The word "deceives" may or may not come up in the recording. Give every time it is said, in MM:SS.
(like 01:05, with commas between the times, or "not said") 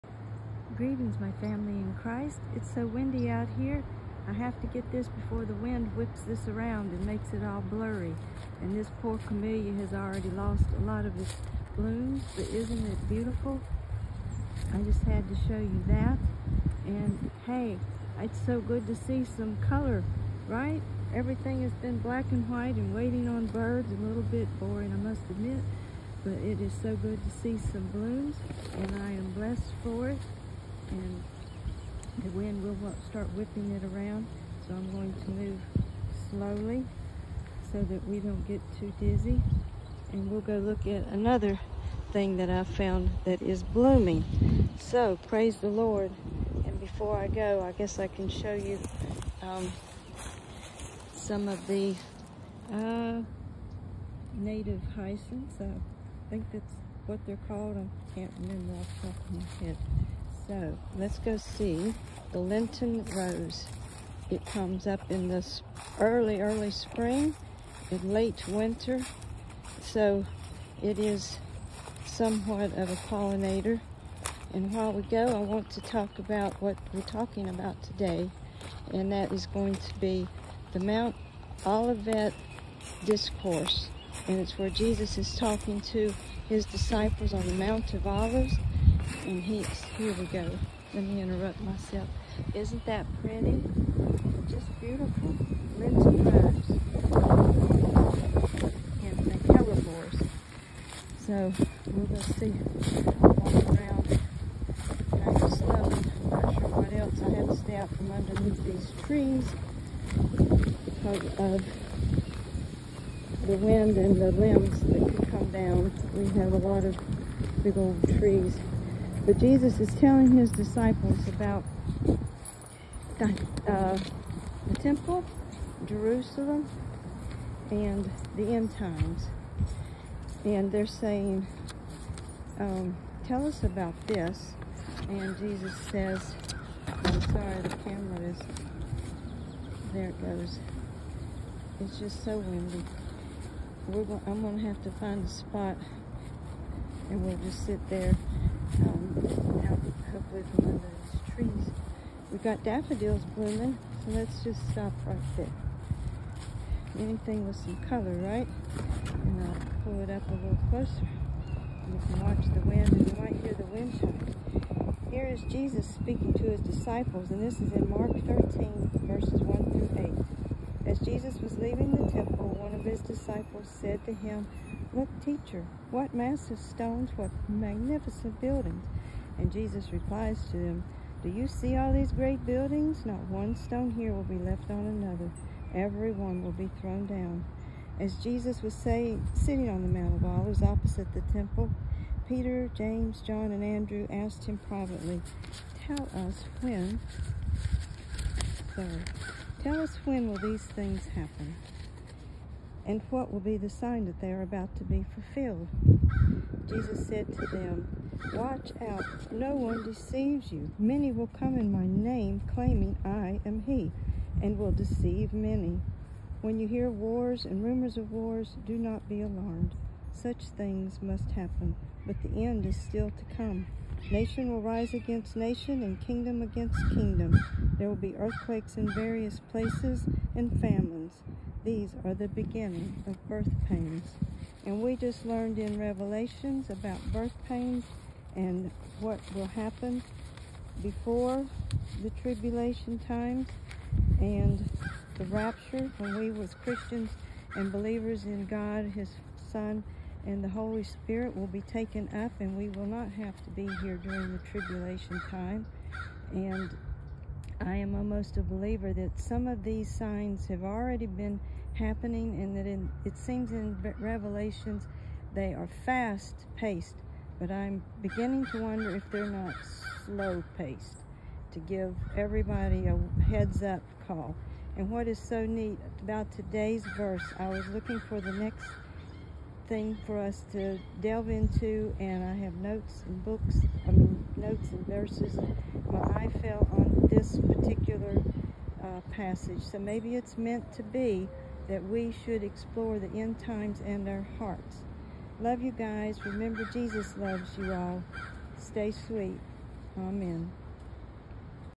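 03:29, 03:34.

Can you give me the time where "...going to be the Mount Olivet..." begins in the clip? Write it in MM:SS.
01:19.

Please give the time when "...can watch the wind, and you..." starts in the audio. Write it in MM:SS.
02:42.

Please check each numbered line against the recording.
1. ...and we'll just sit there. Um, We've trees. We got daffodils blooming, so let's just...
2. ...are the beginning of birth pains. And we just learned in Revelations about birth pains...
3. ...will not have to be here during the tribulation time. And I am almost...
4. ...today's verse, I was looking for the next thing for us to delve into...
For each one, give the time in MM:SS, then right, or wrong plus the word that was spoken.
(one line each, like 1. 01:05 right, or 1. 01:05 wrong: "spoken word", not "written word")
1. 02:27 right
2. 03:52 right
3. 04:12 right
4. 04:36 right.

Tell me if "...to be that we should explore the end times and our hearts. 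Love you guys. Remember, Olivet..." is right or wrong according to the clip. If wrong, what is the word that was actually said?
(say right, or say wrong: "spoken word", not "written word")
wrong: "Jesus", not "Olivet".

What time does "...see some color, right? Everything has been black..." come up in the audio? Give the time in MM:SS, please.
00:18.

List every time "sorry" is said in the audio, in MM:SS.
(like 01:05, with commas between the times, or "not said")
02:17, 03:18.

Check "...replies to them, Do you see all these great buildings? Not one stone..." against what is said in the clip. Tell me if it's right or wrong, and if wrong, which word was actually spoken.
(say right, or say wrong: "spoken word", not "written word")
right.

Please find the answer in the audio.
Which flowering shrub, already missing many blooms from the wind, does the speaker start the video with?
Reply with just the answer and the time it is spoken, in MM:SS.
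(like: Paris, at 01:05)
camellia, at 00:09.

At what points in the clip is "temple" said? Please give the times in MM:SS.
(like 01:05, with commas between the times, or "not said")
02:04, 02:52, 03:11.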